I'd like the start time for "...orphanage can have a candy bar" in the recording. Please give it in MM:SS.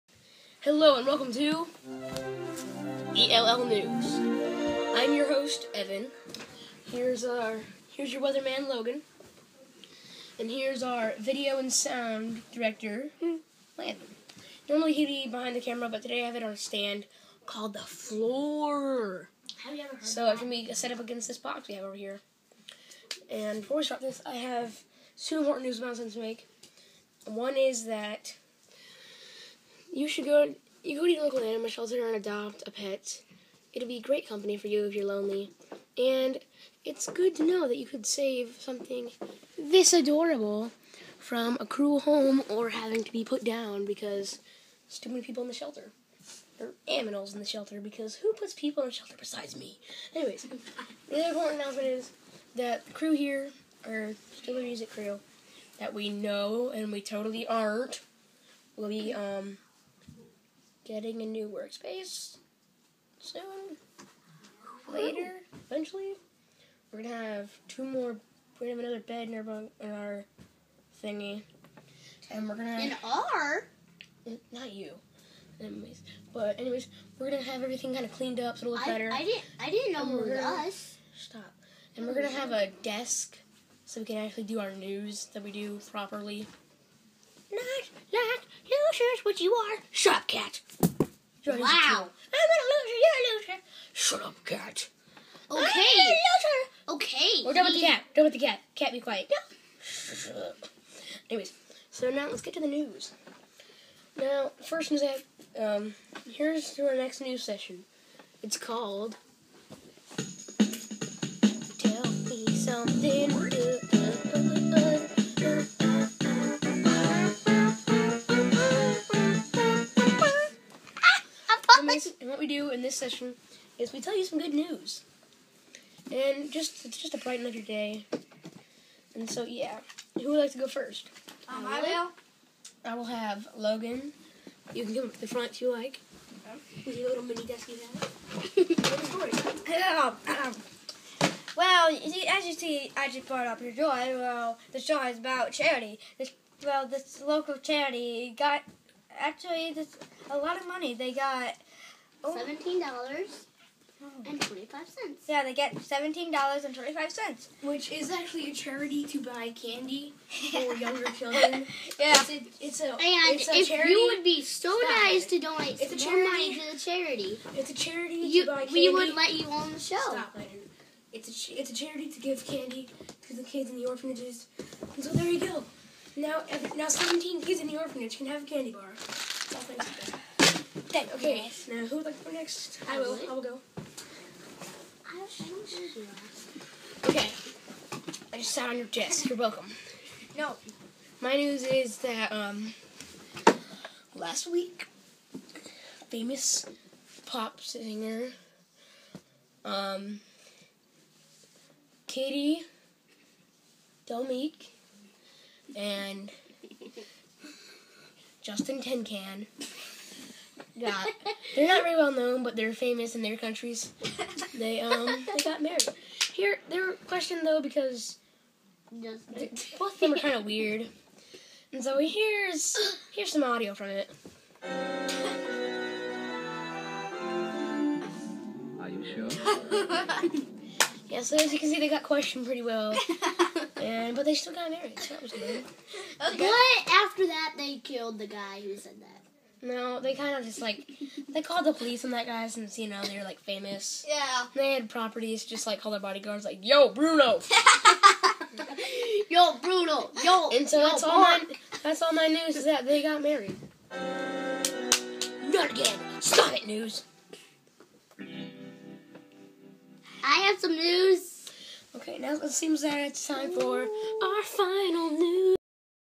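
02:57.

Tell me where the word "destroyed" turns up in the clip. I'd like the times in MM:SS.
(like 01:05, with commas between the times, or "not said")
not said.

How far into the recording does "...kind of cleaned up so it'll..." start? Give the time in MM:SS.
01:17.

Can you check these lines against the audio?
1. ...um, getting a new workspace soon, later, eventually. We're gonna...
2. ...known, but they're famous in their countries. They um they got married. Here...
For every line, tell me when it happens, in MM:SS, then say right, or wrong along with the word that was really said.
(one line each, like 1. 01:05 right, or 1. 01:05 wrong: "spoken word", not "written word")
1. 00:59 right
2. 03:32 right.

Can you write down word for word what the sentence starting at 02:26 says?
This, well, this local charity got actually this a lot of money.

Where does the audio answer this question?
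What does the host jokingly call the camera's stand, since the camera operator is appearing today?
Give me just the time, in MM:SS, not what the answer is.
00:17.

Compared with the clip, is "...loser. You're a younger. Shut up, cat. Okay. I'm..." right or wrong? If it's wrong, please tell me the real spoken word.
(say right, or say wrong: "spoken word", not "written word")
wrong: "loser", not "younger".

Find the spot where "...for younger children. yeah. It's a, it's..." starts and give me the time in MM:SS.
02:40.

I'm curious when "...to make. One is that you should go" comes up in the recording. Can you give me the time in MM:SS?
00:26.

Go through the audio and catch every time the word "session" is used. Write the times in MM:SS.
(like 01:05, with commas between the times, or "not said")
01:47, 02:02.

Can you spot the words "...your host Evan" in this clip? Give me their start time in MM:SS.
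00:05.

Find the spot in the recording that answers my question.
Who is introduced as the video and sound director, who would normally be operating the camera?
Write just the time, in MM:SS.
00:13.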